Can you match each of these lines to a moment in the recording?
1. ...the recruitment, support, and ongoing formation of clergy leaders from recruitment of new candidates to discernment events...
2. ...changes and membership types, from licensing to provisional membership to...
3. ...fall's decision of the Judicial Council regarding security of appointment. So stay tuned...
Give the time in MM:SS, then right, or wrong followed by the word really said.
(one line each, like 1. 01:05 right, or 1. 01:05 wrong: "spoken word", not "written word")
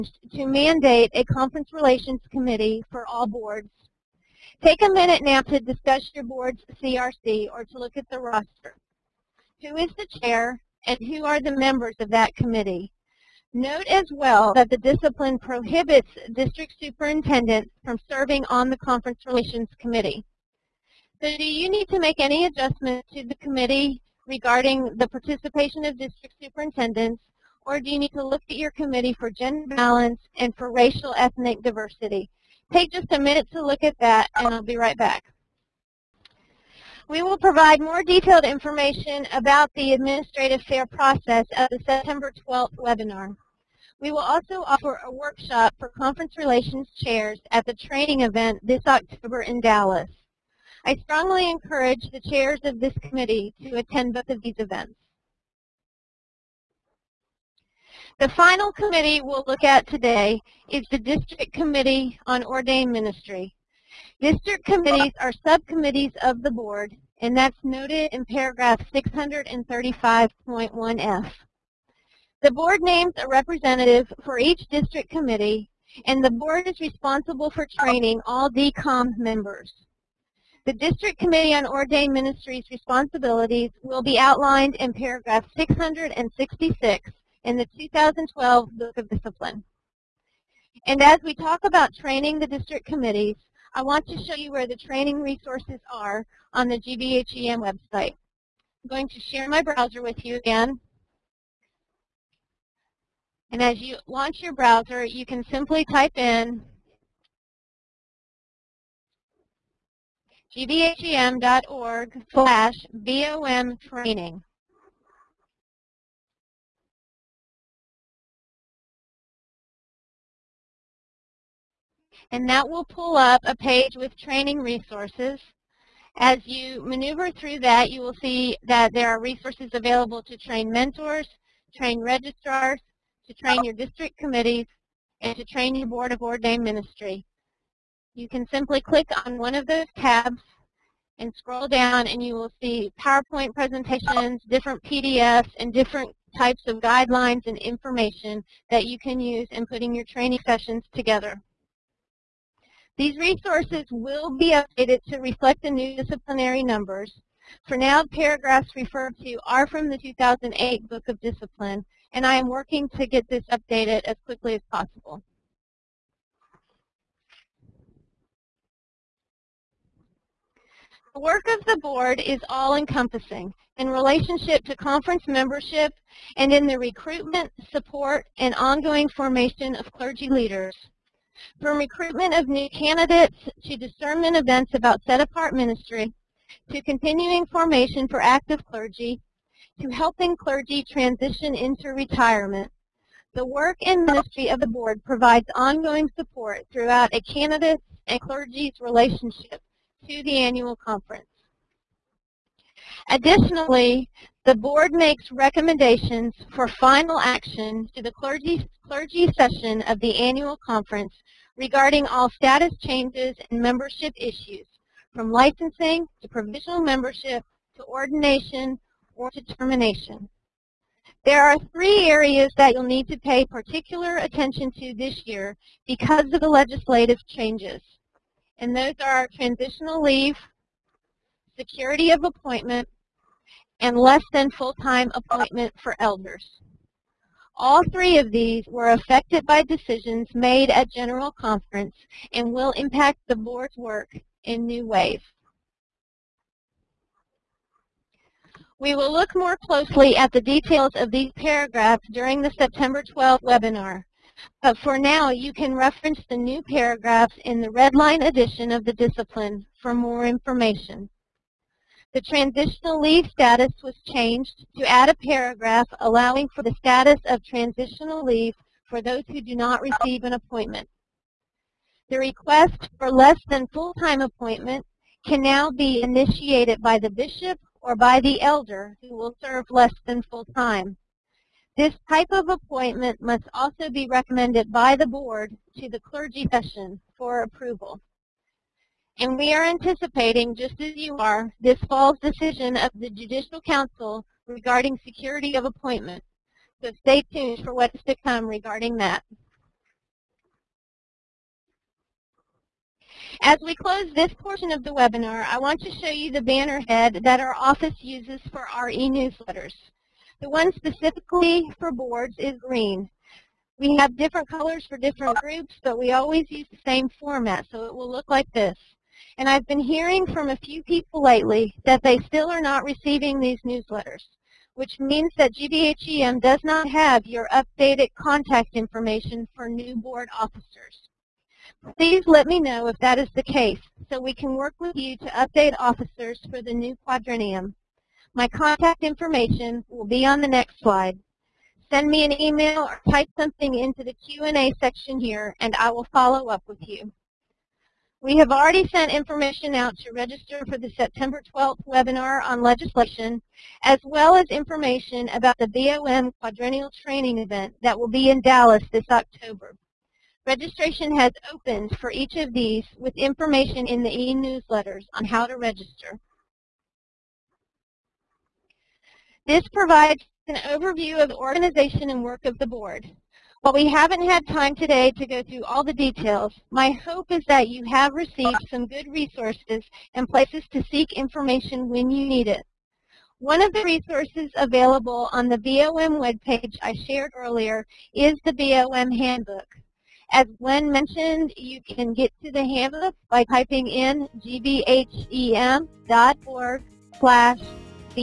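1. 02:56 right
2. 03:32 wrong: "issues", not "types"
3. 04:51 right.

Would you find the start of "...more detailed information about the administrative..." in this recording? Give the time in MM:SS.
00:37.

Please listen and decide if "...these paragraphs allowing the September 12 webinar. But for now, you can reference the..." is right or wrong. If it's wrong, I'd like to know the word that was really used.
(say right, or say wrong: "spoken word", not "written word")
wrong: "during", not "allowing".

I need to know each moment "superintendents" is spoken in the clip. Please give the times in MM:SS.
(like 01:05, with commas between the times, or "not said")
00:16, 00:26.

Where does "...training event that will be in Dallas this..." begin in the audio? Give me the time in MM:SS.
05:57.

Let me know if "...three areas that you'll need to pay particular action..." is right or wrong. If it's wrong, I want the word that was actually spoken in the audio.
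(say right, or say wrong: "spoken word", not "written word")
wrong: "attention", not "action".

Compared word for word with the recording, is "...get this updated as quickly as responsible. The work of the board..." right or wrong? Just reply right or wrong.
wrong.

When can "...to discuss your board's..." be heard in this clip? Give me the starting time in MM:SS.
00:05.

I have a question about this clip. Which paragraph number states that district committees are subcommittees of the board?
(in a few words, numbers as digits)
635.1F.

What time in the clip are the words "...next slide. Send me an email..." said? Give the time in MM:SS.
05:40.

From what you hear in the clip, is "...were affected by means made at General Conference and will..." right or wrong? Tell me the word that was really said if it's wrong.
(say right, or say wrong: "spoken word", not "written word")
wrong: "decisions", not "means".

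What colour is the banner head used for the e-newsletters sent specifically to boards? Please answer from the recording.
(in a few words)
Green.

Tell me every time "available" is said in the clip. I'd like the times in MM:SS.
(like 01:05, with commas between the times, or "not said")
02:09, 06:24.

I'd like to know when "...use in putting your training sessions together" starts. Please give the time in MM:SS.
02:29.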